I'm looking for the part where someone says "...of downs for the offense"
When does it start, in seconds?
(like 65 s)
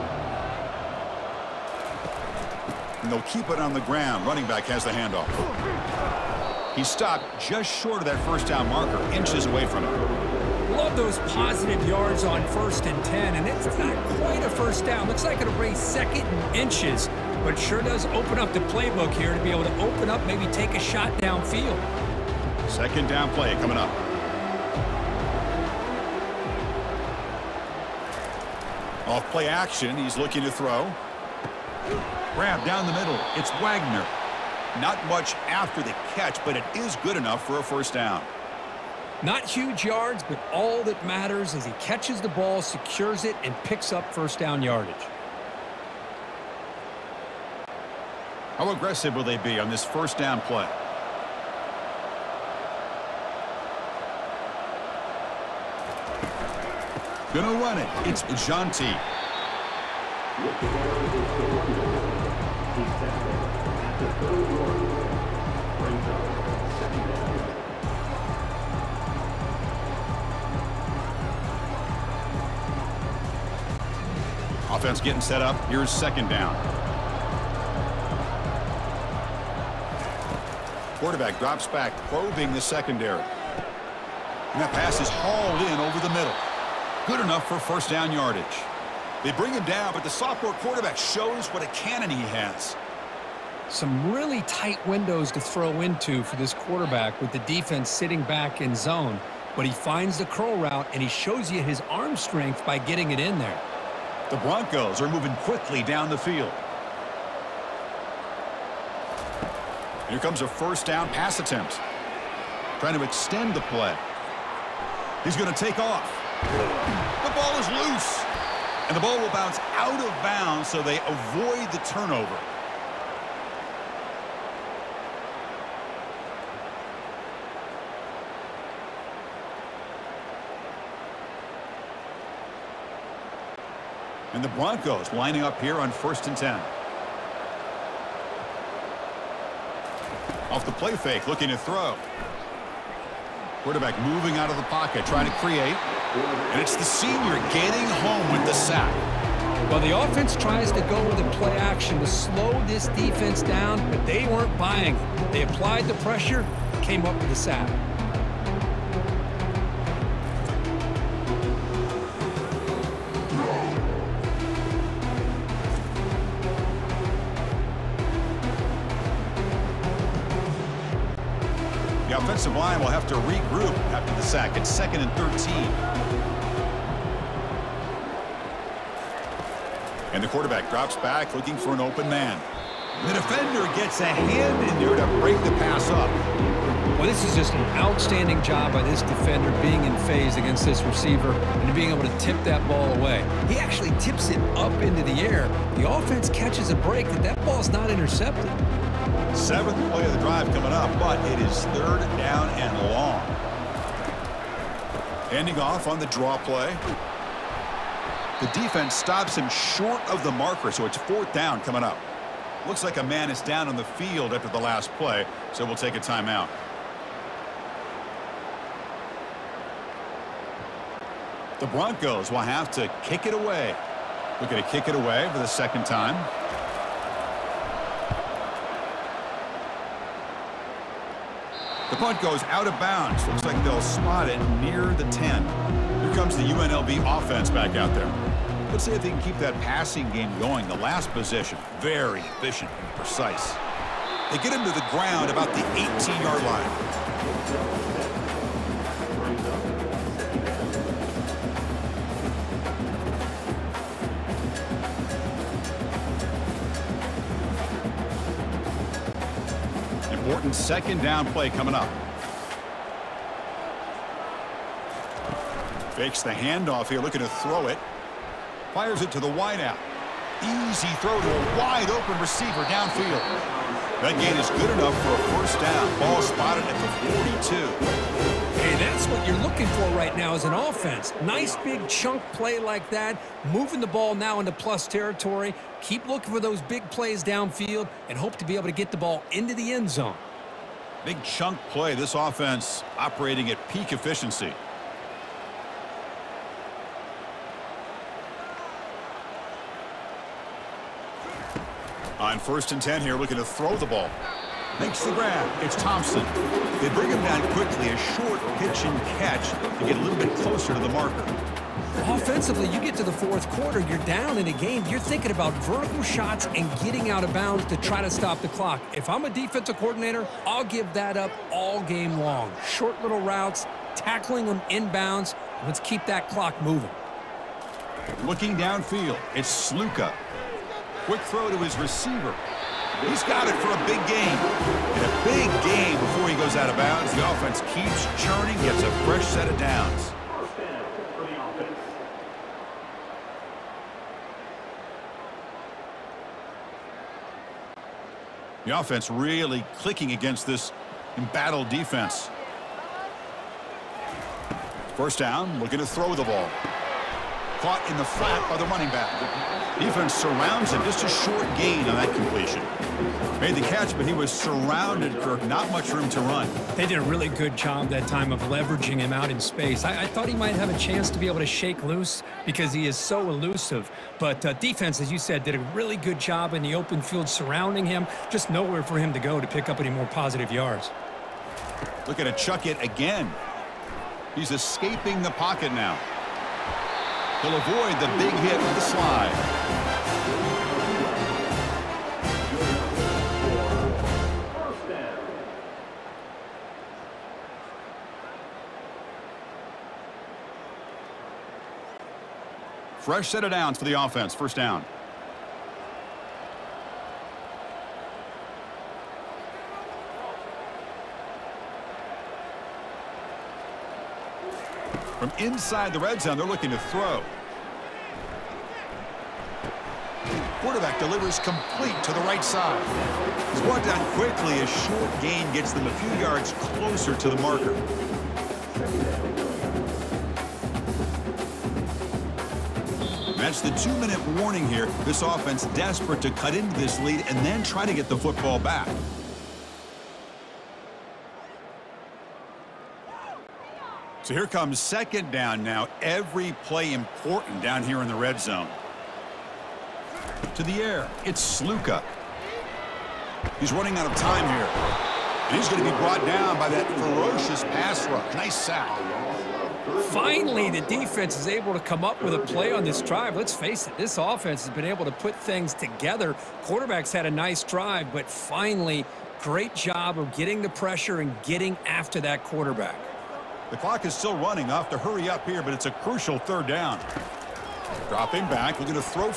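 403 s.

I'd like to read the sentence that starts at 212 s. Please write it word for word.
Looks like a man is down on the field after the last play, so we'll take a timeout.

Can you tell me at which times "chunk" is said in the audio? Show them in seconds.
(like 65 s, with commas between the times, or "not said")
281 s, 291 s.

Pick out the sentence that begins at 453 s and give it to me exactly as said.
He's running out of time here.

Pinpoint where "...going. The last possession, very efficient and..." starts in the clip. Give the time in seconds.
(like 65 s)
240 s.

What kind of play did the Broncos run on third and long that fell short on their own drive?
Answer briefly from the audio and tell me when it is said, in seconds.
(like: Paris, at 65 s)
draw play, at 206 s.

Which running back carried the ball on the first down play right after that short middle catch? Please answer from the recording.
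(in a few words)
Jeanty.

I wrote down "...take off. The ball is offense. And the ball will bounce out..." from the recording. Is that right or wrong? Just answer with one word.
wrong.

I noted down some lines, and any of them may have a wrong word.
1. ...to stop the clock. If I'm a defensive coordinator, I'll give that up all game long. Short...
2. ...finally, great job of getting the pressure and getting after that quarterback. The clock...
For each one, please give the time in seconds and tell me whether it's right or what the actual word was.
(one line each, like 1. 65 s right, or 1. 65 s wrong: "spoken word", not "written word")
1. 318 s right
2. 468 s right.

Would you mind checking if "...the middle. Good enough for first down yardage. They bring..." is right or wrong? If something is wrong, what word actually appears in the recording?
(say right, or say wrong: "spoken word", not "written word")
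right.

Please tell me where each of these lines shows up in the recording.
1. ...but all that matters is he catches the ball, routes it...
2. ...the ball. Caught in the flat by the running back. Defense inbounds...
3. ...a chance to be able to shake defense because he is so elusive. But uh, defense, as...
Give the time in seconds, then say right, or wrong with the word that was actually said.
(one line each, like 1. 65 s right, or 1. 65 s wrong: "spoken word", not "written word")
1. 40 s wrong: "secures", not "routes"
2. 356 s wrong: "surrounds", not "inbounds"
3. 370 s wrong: "loose", not "defense".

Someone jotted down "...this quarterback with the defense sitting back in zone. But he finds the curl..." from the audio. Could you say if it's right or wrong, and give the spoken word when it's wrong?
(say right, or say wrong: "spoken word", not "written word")
right.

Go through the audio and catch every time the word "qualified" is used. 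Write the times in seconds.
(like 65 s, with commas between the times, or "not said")
not said.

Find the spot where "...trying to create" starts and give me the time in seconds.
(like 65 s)
145 s.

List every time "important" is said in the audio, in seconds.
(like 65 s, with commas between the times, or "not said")
260 s, 446 s.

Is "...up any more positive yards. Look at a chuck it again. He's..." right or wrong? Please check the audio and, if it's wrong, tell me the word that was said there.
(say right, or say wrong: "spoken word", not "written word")
right.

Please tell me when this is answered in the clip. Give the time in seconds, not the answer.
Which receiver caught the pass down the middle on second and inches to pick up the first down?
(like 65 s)
33 s.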